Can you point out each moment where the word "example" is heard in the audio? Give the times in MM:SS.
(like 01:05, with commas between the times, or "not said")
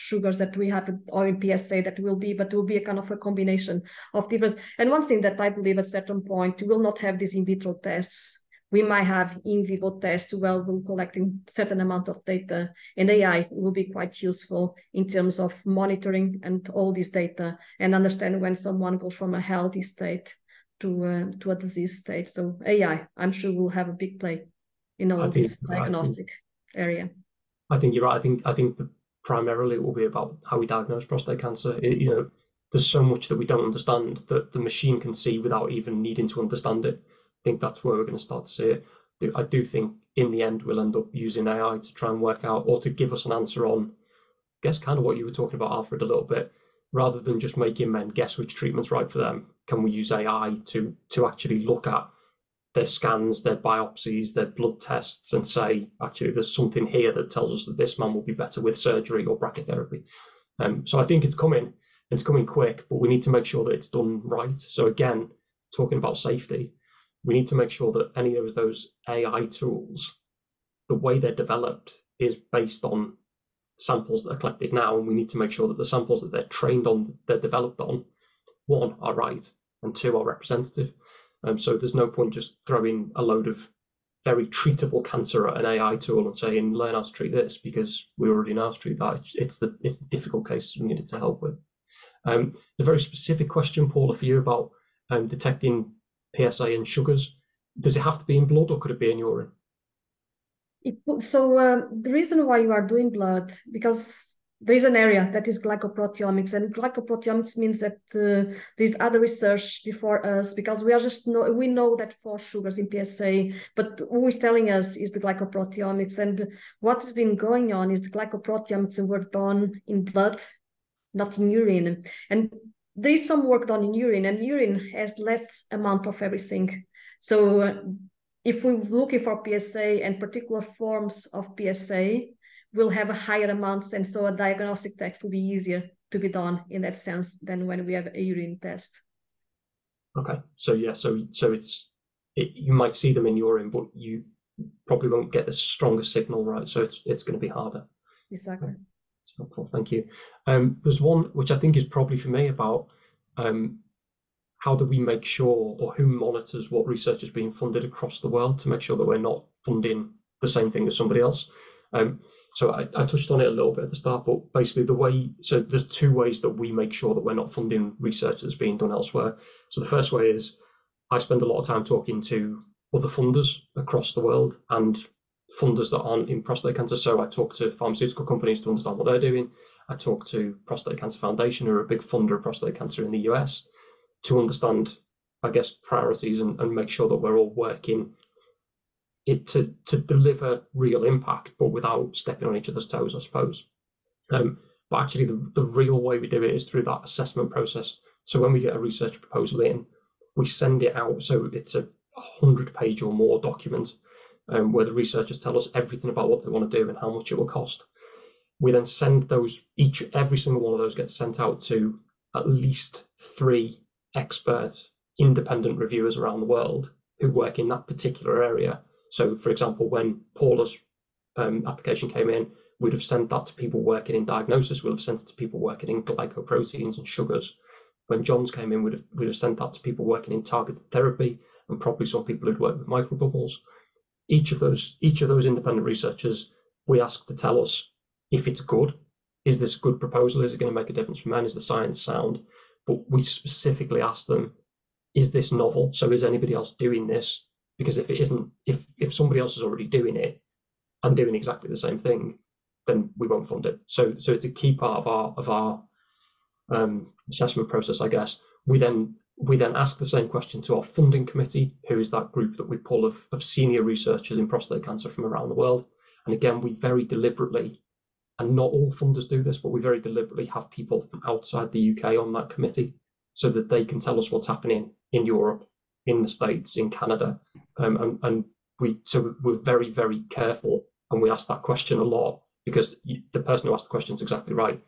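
03:39.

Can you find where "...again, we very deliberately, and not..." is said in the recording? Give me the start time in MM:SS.
04:26.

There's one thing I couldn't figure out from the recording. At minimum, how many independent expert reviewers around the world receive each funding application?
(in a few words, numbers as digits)
3.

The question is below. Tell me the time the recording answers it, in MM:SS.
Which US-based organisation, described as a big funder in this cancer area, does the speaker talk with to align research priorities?
03:00.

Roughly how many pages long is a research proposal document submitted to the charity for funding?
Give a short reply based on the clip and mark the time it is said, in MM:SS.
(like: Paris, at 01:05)
100, at 03:22.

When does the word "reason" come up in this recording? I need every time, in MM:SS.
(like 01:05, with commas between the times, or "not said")
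01:42.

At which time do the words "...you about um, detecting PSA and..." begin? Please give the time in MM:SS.
01:34.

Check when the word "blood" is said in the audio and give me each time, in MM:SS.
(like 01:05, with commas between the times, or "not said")
00:54, 01:38, 01:43, 02:00.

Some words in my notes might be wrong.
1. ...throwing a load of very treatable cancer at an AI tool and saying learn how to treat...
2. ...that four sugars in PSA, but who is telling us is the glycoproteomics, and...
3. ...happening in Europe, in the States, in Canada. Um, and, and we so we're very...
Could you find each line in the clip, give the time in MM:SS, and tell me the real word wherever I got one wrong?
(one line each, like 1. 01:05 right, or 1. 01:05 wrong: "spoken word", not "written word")
1. 01:22 right
2. 01:51 right
3. 04:34 right.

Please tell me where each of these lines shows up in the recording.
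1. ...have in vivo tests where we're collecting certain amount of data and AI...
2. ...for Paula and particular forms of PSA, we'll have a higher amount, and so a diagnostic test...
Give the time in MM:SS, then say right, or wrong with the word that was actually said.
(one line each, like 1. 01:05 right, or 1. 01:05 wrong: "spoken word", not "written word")
1. 00:09 right
2. 02:09 wrong: "PSA", not "Paula".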